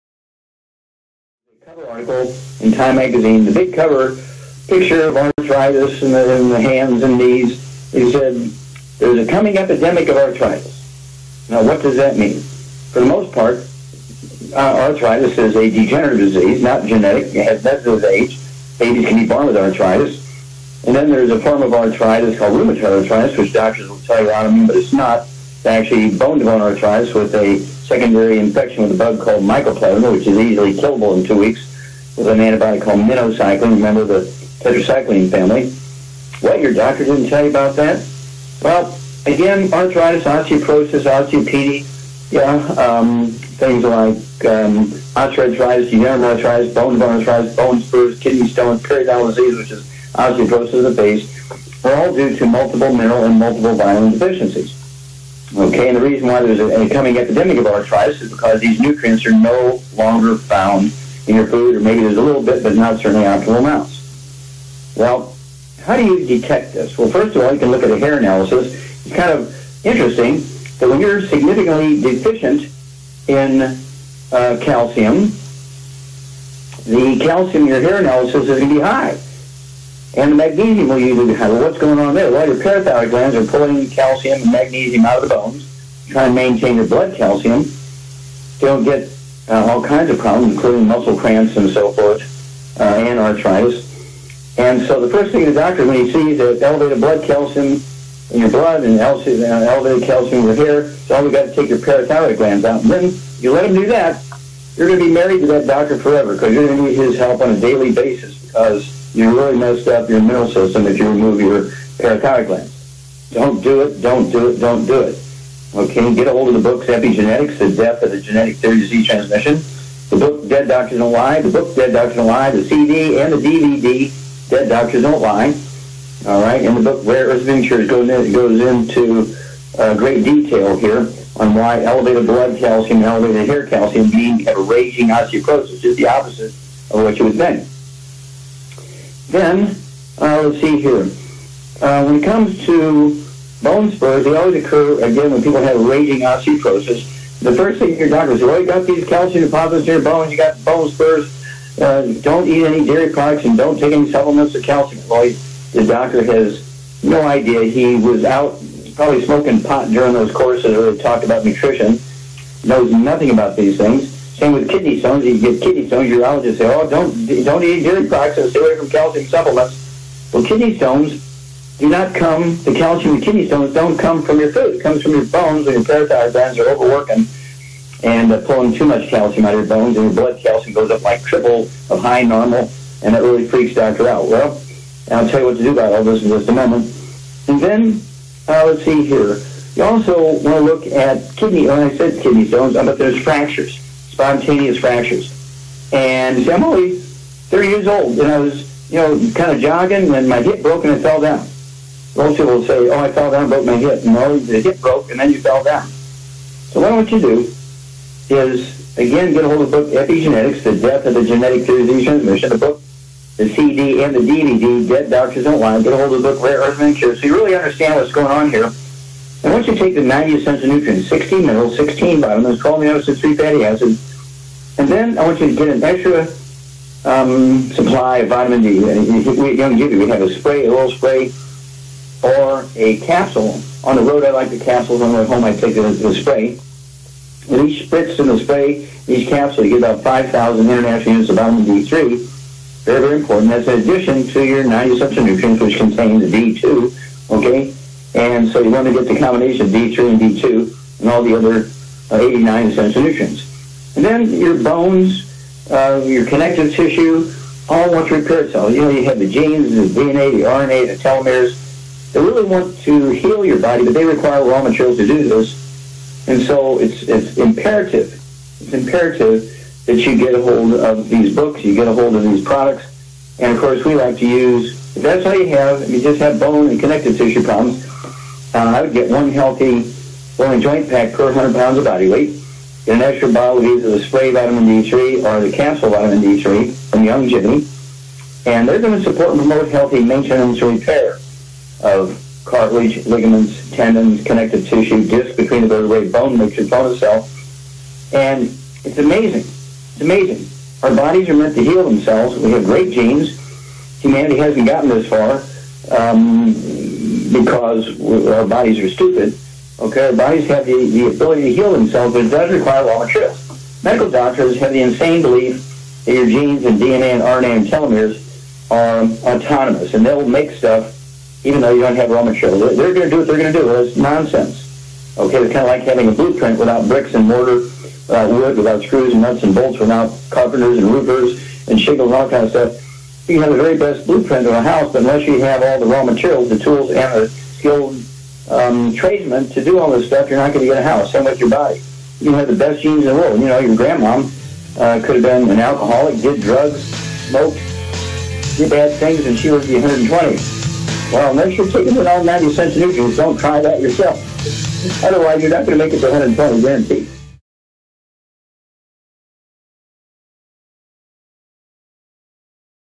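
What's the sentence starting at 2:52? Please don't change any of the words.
The calcium and kidney stones don't come from your food.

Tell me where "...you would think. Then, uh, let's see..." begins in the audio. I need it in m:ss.
2:17.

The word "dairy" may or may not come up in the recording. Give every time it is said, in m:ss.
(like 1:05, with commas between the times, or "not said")
2:32, 2:47.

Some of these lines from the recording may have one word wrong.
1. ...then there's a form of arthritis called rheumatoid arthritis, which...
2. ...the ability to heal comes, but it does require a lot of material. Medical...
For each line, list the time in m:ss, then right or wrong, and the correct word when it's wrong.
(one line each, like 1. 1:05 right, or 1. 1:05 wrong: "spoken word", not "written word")
1. 0:20 right
2. 5:10 wrong: "themselves", not "comes".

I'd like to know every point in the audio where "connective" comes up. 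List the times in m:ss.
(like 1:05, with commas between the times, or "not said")
4:16, 4:36, 4:54.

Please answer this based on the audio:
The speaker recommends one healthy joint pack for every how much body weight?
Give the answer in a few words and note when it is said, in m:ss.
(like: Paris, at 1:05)
100 pounds, at 4:41.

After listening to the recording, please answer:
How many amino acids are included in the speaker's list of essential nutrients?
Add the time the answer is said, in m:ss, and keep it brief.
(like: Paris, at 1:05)
12, at 3:42.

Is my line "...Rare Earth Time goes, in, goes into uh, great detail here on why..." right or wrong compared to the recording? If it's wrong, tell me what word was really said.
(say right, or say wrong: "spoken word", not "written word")
wrong: "Ventures", not "Time".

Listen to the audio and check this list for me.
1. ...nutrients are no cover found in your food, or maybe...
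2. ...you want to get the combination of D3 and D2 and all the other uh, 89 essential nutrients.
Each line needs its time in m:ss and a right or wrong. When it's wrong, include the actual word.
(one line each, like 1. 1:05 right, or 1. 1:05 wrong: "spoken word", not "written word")
1. 0:58 wrong: "longer", not "cover"
2. 4:08 right.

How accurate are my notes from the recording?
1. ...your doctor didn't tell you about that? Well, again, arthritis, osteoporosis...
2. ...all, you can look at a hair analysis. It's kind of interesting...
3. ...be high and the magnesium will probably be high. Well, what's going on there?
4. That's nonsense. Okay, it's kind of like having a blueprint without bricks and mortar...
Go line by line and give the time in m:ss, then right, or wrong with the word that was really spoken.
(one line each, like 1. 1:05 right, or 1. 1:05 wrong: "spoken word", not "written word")
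1. 0:36 right
2. 1:07 right
3. 1:18 wrong: "usually", not "probably"
4. 5:23 right.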